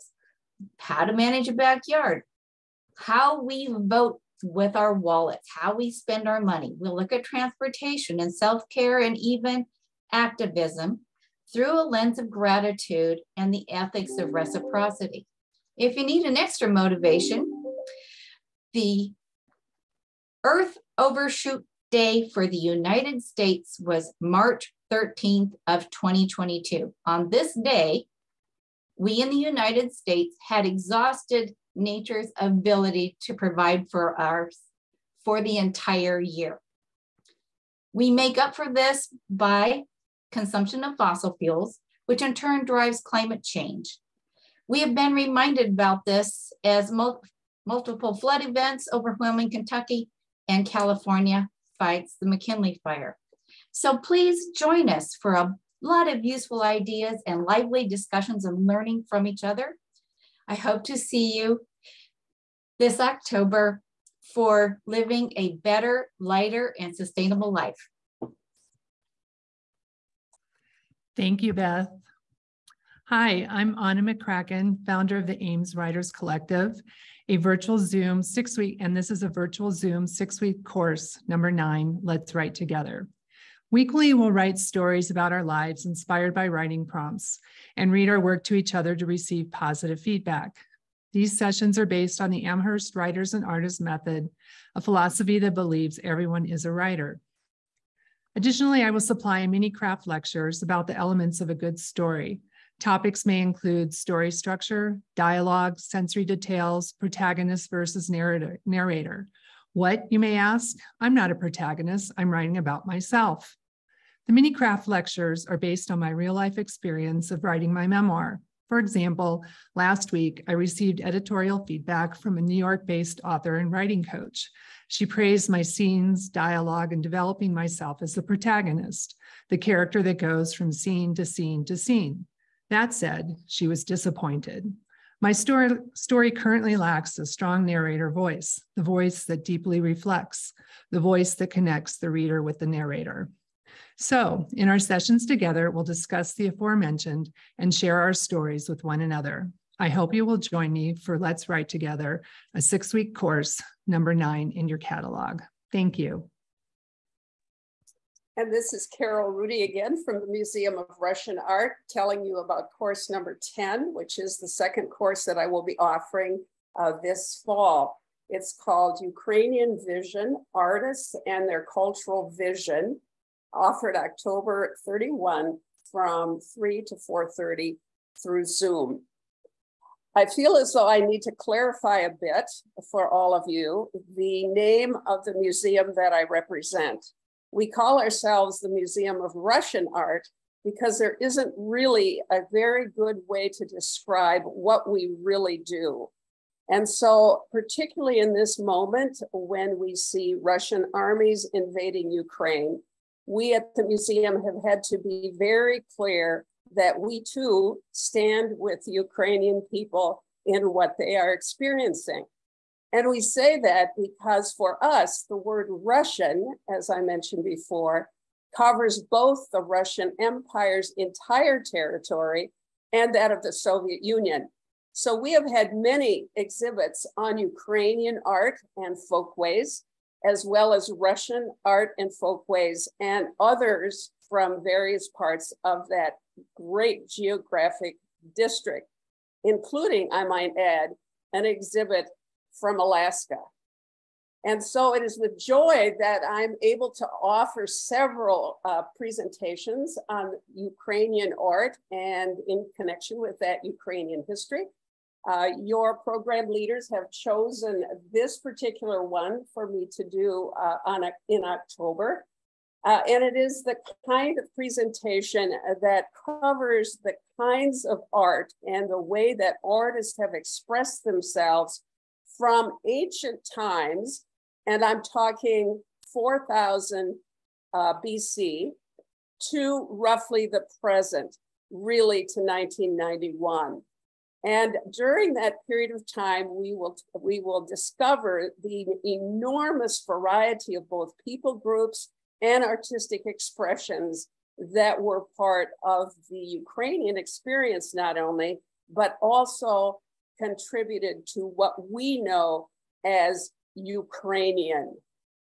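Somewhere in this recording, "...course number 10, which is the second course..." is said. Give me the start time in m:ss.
2:42.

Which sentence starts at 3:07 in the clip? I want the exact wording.
We call ourselves the Museum of Russian Art because there isn't really a very good way to describe what we really do.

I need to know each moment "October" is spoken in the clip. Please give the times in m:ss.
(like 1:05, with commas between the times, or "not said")
1:02, 2:53, 4:21.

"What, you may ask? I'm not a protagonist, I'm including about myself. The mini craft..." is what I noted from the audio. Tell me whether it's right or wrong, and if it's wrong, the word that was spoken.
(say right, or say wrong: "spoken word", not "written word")
wrong: "writing", not "including".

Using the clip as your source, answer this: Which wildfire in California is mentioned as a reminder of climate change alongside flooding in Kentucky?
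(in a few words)
McKinley Fire.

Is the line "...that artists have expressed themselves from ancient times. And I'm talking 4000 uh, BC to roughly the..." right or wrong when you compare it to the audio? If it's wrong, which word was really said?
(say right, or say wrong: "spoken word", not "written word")
right.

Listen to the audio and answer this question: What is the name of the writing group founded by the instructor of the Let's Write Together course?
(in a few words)
Ames Writers Collective.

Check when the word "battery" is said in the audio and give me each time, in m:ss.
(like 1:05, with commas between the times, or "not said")
not said.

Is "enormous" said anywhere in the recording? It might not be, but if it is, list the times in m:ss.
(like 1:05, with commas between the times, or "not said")
4:49.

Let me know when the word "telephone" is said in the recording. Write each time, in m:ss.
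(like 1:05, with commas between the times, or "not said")
not said.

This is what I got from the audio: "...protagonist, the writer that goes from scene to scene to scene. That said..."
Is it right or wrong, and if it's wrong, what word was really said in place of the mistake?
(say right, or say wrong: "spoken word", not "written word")
wrong: "character", not "writer".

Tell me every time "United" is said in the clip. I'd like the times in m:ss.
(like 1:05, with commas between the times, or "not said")
0:22, 0:29.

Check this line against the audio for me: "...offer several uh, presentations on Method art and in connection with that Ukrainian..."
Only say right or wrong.
wrong.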